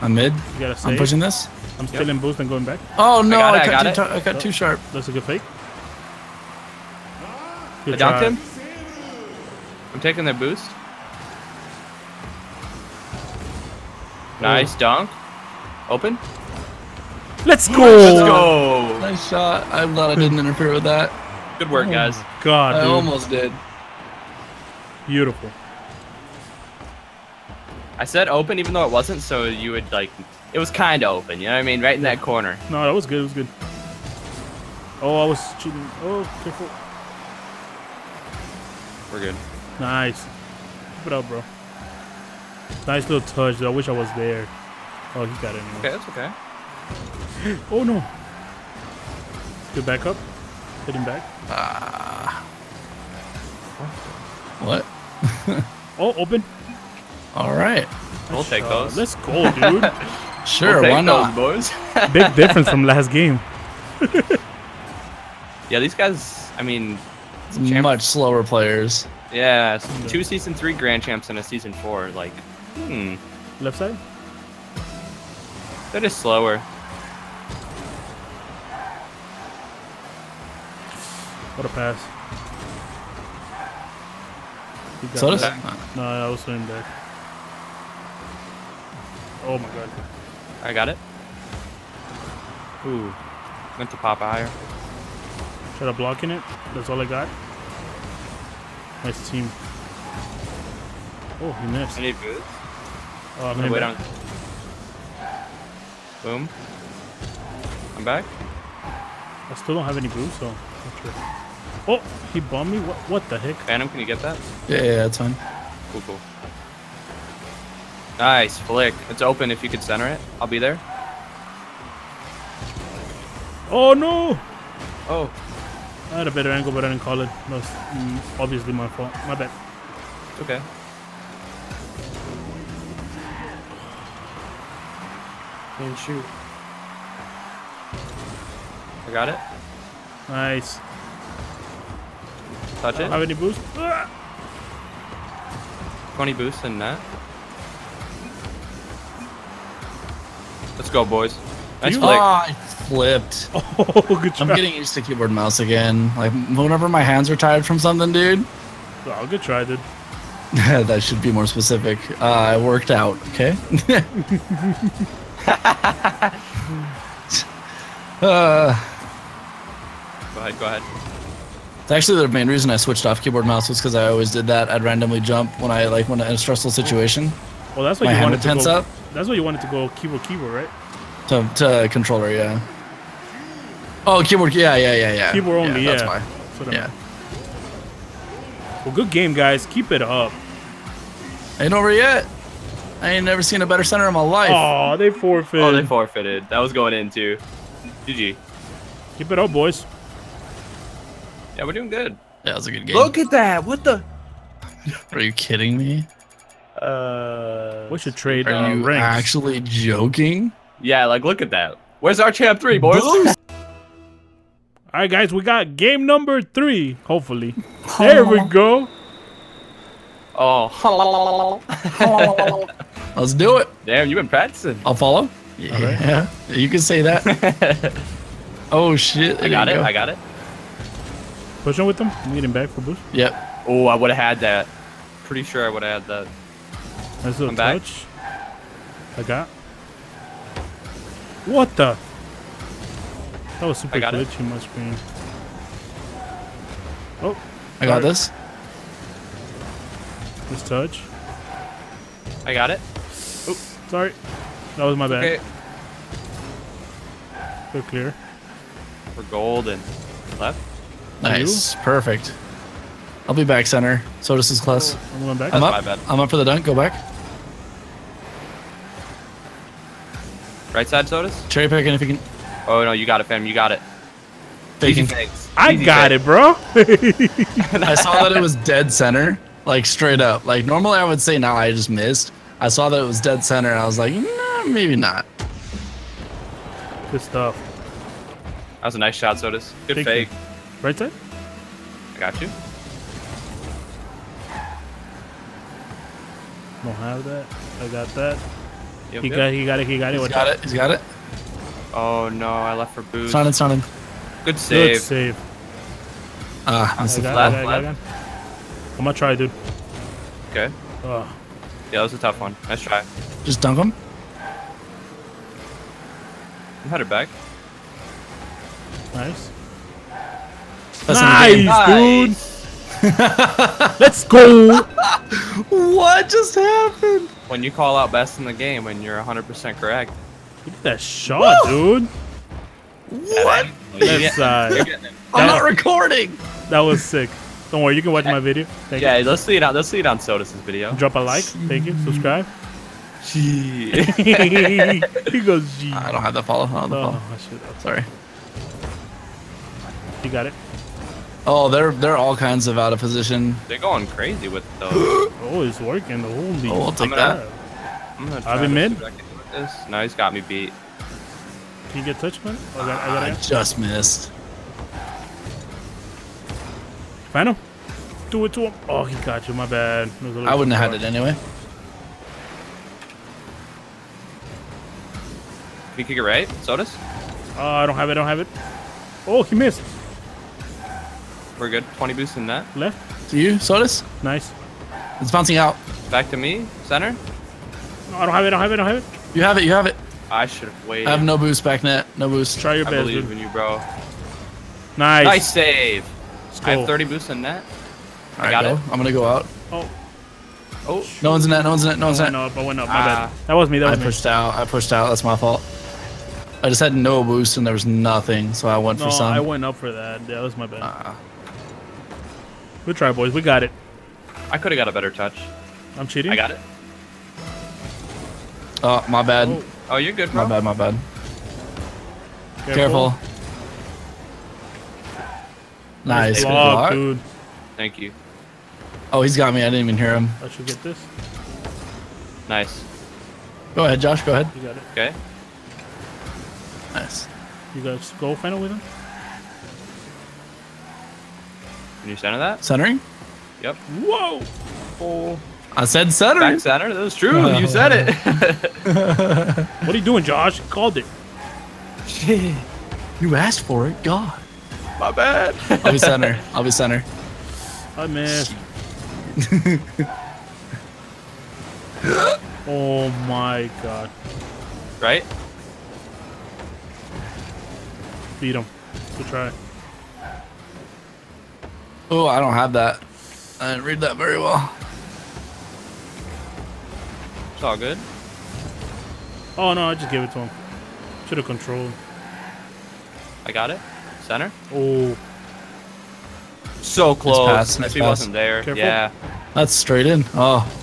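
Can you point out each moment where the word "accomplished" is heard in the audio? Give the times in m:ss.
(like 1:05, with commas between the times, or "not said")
not said.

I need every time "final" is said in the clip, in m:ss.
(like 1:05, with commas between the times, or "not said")
6:07, 7:18.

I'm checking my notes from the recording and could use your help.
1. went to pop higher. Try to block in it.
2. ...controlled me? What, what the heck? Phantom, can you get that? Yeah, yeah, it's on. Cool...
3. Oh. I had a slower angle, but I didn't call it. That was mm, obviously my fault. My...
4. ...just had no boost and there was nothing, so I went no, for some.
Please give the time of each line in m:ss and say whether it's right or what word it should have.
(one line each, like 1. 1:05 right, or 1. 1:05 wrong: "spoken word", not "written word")
1. 1:33 right
2. 1:52 wrong: "bombed", not "controlled"
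3. 2:05 wrong: "better", not "slower"
4. 6:46 right.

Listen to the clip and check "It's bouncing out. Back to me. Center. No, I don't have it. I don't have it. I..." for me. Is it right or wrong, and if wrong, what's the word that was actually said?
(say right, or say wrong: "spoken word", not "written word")
right.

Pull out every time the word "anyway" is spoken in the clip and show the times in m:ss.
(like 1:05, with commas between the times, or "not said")
0:45, 6:11.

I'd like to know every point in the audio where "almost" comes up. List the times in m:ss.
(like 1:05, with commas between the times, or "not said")
0:22.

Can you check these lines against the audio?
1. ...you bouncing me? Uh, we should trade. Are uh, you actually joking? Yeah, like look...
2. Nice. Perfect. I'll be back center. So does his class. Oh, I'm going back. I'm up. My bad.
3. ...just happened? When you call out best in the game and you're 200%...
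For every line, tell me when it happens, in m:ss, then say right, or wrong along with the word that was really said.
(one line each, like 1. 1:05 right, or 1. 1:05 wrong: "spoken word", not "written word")
1. 3:25 wrong: "kidding", not "bouncing"
2. 4:21 right
3. 5:26 wrong: "100", not "200".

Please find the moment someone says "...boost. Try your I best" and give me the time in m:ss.
6:32.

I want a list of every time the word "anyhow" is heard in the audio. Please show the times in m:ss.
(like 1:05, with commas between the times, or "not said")
not said.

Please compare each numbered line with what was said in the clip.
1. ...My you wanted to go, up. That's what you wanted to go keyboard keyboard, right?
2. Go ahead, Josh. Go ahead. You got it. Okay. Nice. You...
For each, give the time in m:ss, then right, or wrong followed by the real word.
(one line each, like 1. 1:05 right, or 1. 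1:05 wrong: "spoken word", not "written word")
1. 2:58 right
2. 7:13 right.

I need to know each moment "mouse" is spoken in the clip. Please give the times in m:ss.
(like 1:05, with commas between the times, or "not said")
2:35, 2:53.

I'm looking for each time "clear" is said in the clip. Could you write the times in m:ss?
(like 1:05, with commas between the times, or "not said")
4:17.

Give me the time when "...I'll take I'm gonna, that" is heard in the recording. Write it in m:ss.
5:56.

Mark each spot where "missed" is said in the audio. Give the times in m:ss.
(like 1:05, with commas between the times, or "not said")
1:41, 4:41, 6:03, 6:19, 7:38.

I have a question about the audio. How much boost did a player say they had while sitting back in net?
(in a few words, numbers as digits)
30.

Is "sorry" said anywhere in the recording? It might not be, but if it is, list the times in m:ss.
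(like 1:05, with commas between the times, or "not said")
4:13, 5:47.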